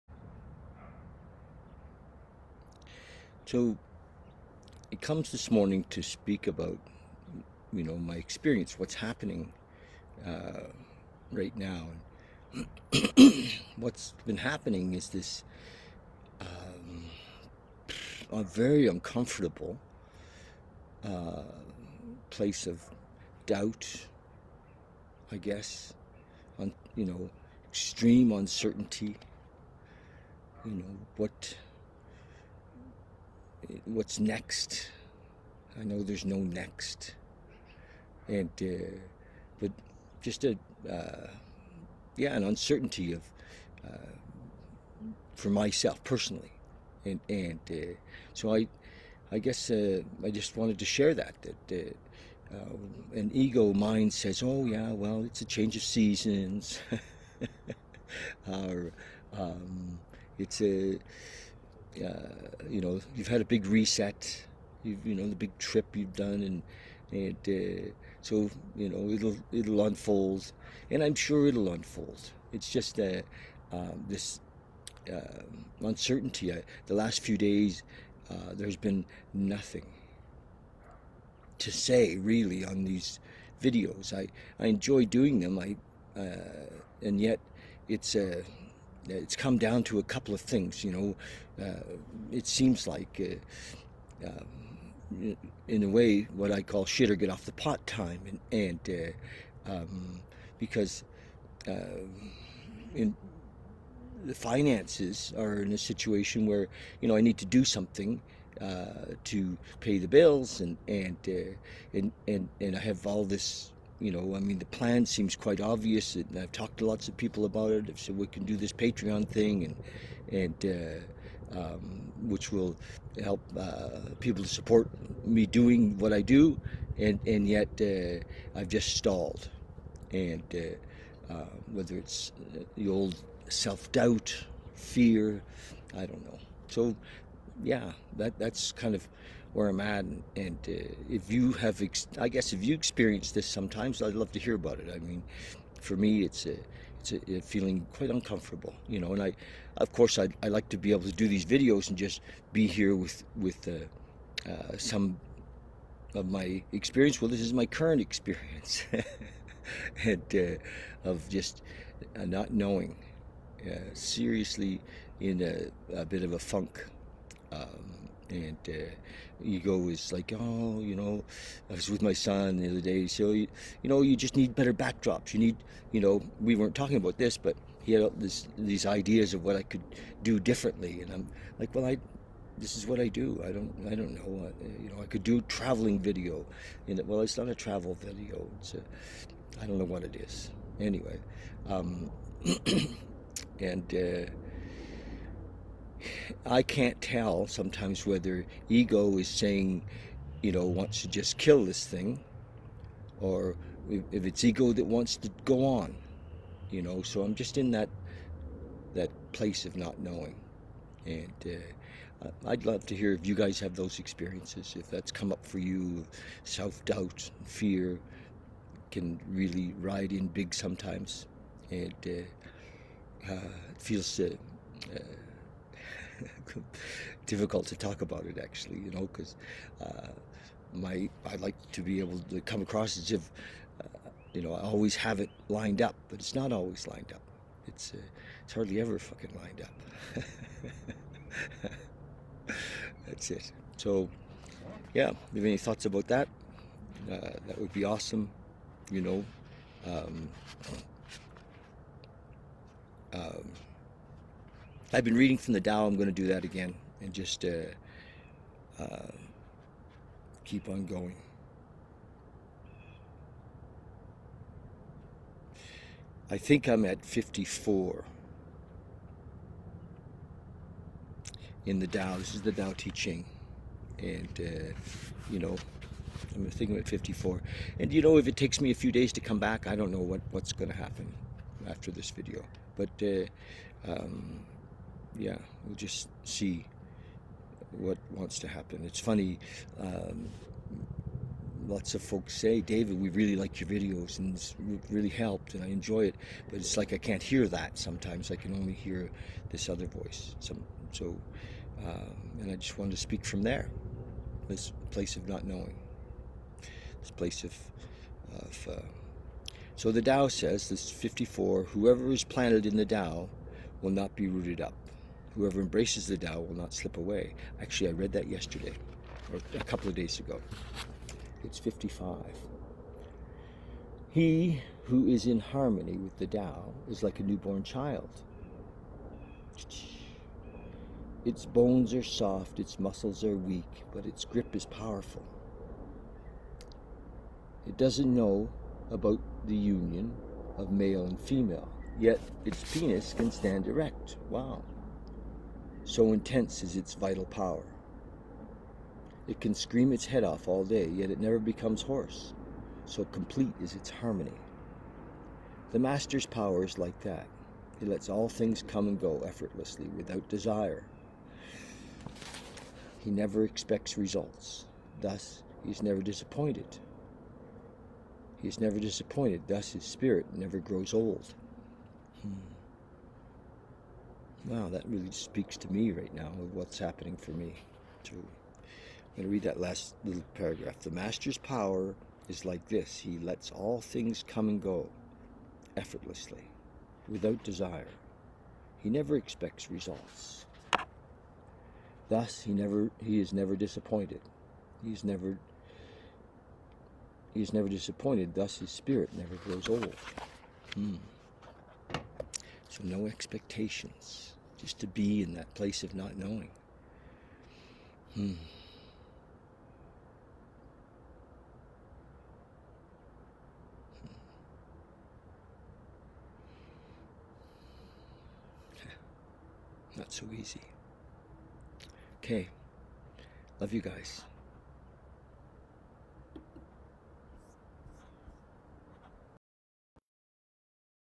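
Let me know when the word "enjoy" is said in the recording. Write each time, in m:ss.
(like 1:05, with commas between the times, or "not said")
1:24, 4:55.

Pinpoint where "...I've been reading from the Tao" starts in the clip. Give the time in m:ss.
4:14.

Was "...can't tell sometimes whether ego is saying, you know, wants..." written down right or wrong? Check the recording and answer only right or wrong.
right.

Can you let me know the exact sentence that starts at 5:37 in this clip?
It doesn't know about the union of male and female, yet its penis can stand erect.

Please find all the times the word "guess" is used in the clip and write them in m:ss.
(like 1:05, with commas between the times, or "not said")
0:25, 0:49, 2:22.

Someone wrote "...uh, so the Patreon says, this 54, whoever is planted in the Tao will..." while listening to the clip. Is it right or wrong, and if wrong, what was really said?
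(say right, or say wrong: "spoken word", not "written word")
wrong: "Tao", not "Patreon".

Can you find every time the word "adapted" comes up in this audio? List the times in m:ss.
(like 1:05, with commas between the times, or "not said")
not said.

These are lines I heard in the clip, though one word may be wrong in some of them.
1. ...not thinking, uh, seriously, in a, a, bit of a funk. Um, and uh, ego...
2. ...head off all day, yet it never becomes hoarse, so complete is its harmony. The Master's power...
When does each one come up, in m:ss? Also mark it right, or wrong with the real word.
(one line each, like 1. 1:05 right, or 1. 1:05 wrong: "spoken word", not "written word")
1. 2:42 wrong: "knowing", not "thinking"
2. 5:50 right.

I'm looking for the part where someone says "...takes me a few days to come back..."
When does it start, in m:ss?
4:38.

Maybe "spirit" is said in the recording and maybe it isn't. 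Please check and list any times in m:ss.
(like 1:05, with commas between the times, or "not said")
6:09, 6:38.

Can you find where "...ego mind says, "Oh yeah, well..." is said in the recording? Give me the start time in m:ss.
0:53.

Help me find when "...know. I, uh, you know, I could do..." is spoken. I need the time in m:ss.
3:04.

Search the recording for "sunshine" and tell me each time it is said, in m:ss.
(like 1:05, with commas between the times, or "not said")
not said.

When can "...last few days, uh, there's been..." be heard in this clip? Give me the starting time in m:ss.
1:16.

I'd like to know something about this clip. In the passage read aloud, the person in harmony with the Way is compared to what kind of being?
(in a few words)
A newborn child.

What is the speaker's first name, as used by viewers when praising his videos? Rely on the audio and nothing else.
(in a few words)
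David.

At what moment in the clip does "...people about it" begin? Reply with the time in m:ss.
1:57.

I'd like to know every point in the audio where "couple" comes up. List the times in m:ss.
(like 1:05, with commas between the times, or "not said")
1:30, 5:19.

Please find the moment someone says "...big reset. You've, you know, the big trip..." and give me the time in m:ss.
1:03.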